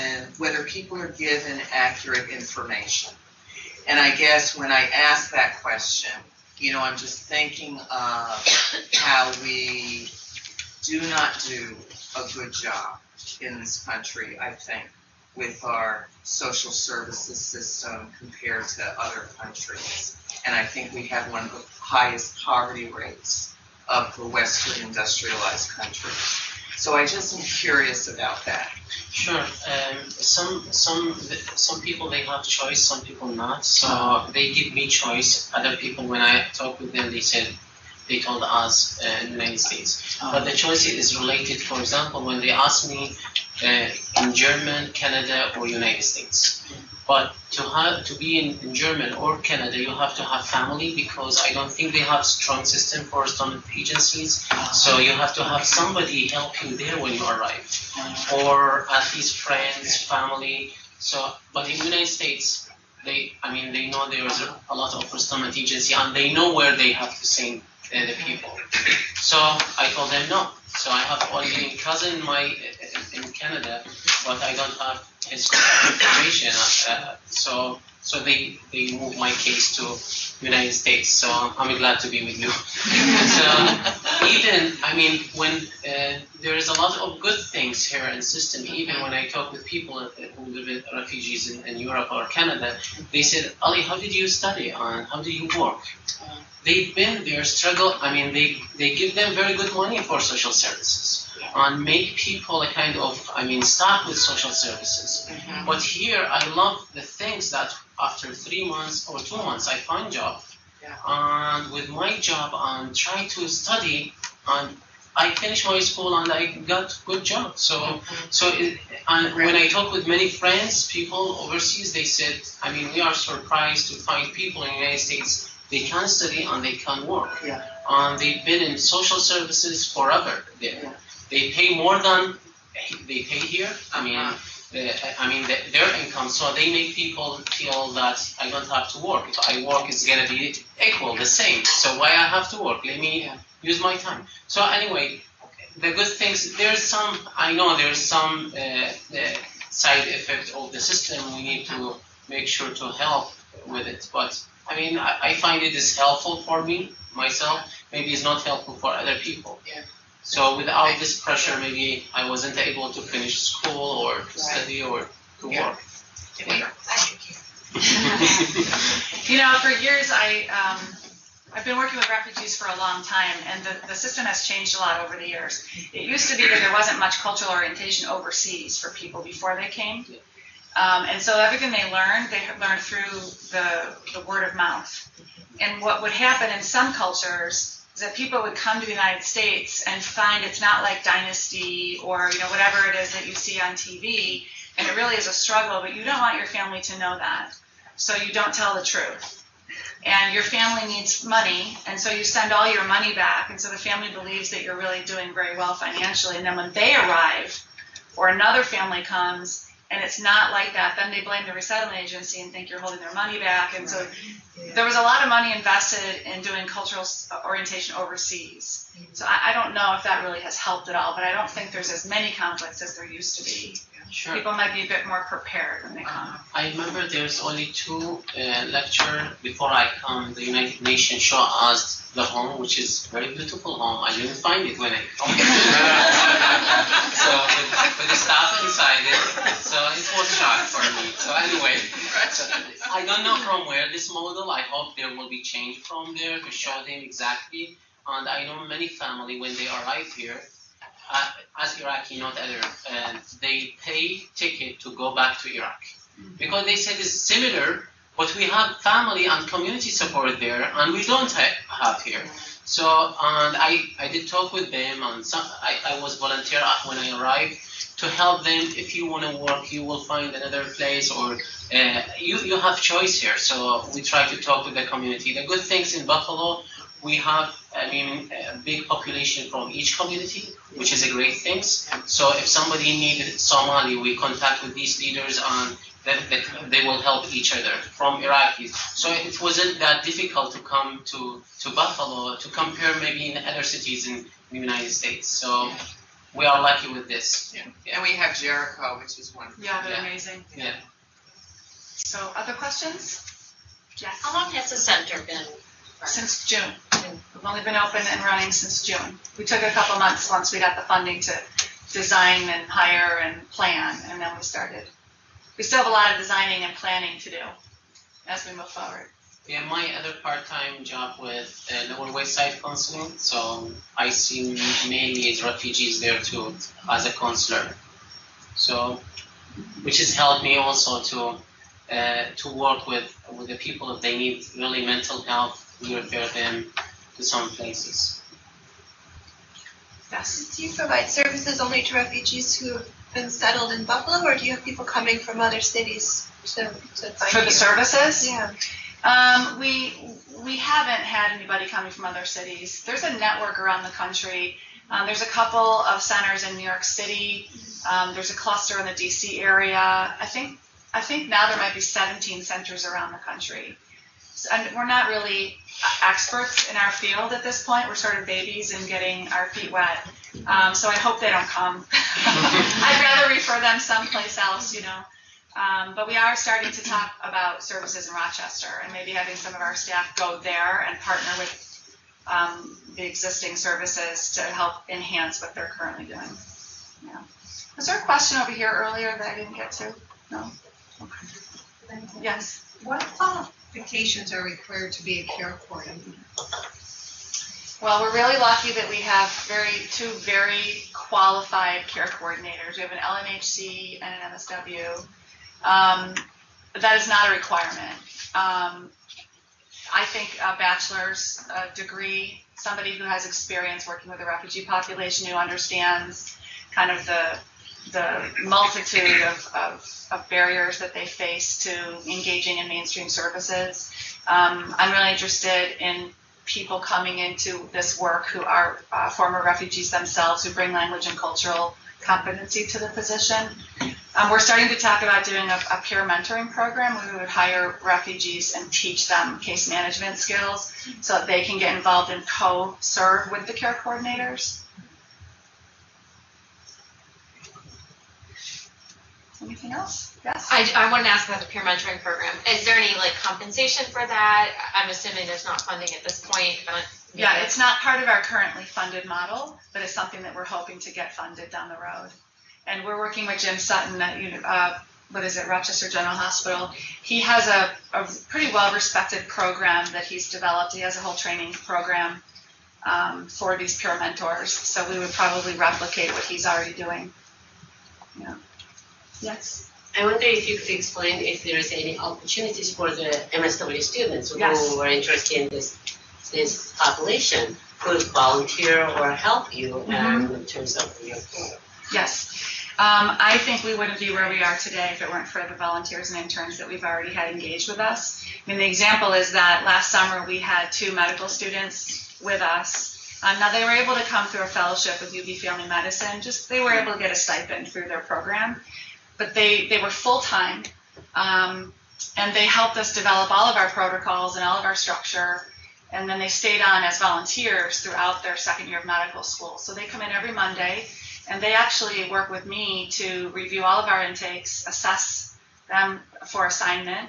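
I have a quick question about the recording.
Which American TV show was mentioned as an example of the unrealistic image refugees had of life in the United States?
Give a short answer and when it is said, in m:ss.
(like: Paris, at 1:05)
Dynasty, at 3:11.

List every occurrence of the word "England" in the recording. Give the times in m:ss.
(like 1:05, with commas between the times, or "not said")
not said.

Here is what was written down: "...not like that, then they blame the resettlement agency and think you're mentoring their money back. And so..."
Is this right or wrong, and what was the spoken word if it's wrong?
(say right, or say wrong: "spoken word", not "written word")
wrong: "holding", not "mentoring".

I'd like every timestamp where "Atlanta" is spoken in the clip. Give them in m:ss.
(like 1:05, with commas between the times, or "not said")
not said.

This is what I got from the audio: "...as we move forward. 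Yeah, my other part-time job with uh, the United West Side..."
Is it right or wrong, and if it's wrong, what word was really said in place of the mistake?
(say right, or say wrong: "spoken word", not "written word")
wrong: "Lower", not "United".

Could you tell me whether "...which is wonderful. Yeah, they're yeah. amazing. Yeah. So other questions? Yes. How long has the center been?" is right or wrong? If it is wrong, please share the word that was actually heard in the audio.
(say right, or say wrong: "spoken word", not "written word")
right.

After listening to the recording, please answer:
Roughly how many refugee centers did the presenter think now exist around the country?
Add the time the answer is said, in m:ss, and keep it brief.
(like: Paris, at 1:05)
17, at 6:01.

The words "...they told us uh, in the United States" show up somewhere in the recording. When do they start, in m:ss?
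0:38.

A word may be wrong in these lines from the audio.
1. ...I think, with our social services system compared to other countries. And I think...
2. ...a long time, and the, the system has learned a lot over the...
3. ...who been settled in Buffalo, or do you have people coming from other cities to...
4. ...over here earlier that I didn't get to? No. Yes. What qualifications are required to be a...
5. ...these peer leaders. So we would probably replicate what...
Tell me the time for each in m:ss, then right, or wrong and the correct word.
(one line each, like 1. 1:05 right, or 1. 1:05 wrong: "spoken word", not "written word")
1. 0:14 right
2. 2:52 wrong: "changed", not "learned"
3. 5:42 right
4. 6:28 right
5. 7:53 wrong: "mentors", not "leaders".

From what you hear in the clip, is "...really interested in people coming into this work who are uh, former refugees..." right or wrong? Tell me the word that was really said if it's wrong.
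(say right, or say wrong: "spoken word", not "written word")
right.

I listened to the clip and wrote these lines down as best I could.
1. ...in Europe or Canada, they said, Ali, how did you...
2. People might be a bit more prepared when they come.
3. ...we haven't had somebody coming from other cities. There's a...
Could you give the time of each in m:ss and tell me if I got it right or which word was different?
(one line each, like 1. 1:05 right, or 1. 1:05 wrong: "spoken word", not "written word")
1. 1:31 right
2. 3:44 right
3. 5:50 wrong: "anybody", not "somebody".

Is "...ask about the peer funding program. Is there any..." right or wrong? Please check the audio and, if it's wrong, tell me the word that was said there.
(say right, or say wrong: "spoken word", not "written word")
wrong: "mentoring", not "funding".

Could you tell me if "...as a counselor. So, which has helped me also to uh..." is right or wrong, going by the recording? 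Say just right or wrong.
right.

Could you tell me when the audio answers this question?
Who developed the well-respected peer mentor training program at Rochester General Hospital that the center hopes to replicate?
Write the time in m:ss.
7:43.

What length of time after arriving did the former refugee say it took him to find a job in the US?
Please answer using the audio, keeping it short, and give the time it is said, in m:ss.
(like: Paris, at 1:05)
two months, at 1:49.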